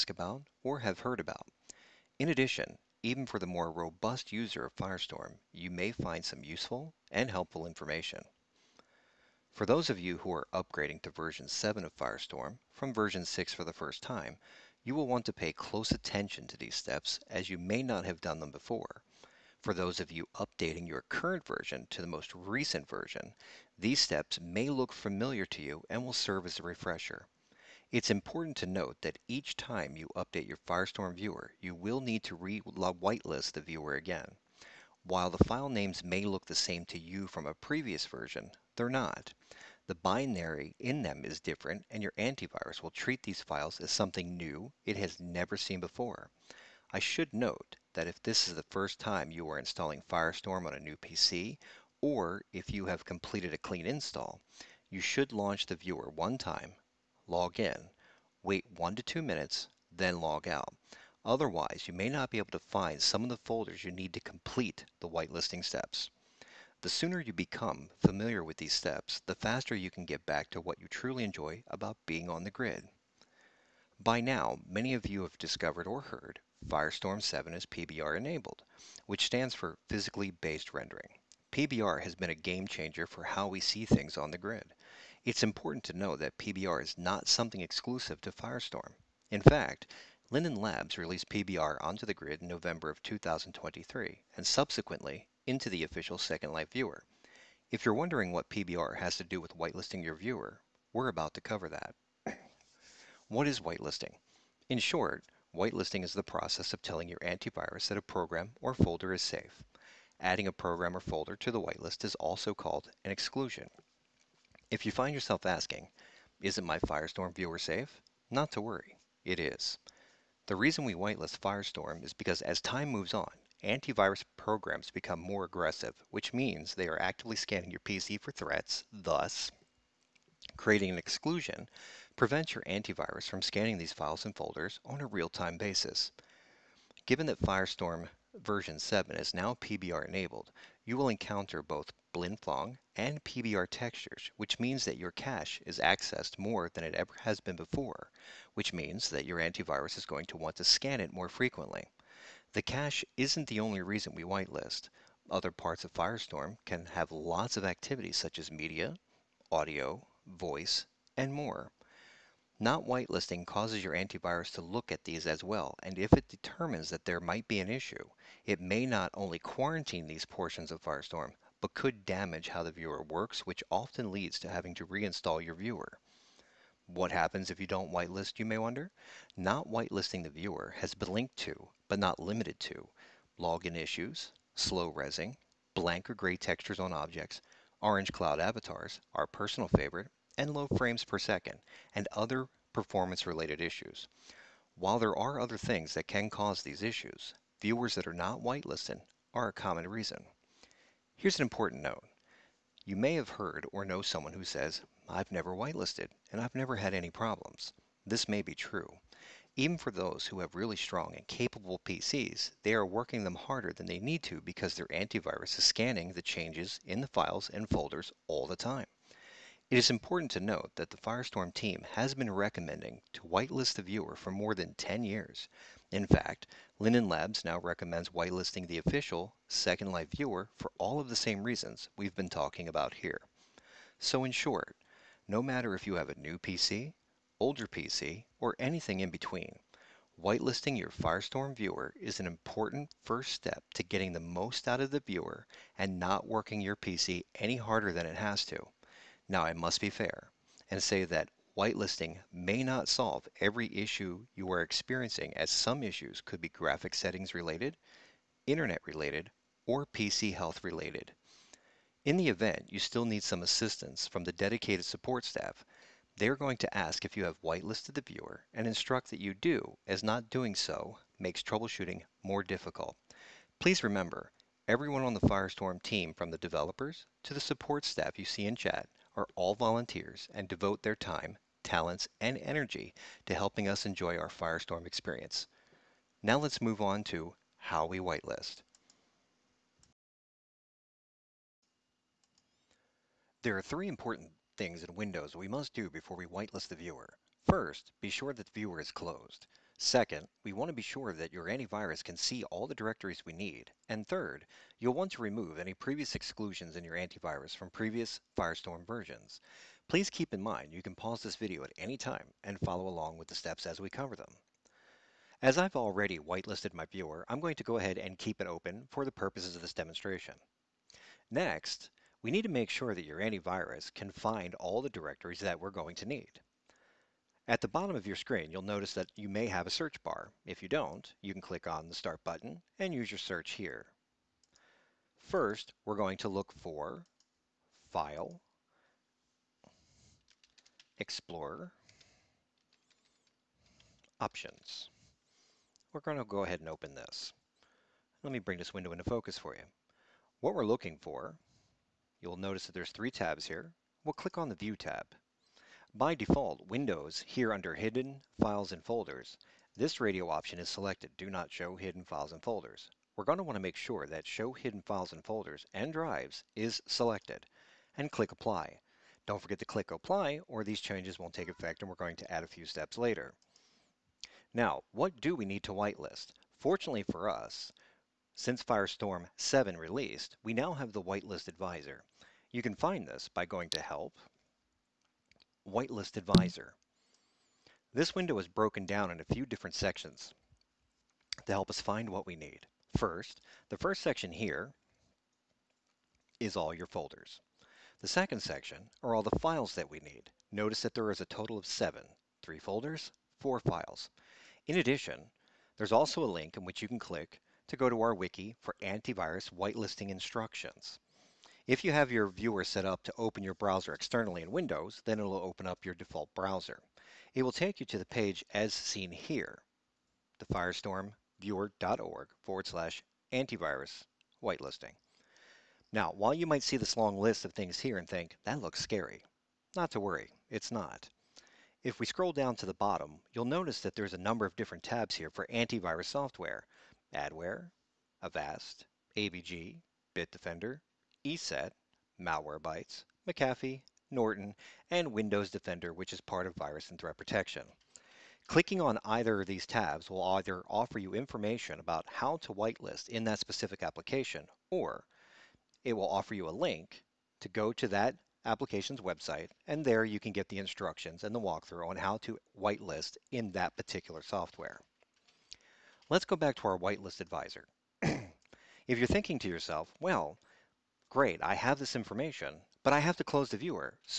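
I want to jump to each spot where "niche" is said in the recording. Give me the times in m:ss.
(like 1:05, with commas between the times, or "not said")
not said.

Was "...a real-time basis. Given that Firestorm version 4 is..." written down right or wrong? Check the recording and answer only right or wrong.
wrong.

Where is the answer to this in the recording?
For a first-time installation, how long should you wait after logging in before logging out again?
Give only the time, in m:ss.
0:58.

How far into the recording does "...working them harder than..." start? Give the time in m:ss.
3:32.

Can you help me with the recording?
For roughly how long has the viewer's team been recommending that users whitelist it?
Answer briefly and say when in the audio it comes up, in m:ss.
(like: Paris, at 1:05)
more than 10 years, at 3:44.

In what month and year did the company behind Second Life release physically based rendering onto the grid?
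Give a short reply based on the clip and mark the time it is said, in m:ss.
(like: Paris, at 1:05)
November 2023, at 1:32.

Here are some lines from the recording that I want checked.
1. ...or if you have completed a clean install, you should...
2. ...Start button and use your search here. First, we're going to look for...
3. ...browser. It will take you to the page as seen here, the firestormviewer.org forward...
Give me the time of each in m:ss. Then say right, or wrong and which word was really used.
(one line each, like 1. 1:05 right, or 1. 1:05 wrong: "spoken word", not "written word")
1. 0:52 right
2. 5:31 right
3. 6:56 right.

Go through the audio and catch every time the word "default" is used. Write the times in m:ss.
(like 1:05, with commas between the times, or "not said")
5:56, 6:55.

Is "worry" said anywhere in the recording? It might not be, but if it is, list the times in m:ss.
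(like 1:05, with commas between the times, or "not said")
1:58, 7:10.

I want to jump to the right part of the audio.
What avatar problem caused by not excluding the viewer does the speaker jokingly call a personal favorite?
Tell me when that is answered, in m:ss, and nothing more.
3:07.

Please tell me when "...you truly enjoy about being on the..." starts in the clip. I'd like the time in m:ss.
1:10.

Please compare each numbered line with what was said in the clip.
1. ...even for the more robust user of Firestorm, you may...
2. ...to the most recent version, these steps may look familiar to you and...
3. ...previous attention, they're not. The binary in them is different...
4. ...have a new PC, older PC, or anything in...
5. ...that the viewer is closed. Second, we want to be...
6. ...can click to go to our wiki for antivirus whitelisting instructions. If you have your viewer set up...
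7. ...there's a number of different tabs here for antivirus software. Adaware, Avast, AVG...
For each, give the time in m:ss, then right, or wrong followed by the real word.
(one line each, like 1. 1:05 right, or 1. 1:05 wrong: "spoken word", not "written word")
1. 0:03 right
2. 0:21 right
3. 0:37 wrong: "version", not "attention"
4. 3:55 right
5. 4:58 right
6. 6:46 right
7. 7:13 right.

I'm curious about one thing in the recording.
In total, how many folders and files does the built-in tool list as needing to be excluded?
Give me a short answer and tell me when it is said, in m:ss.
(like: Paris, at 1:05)
7, at 6:41.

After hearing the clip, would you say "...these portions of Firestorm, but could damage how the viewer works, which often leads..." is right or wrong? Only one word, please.
right.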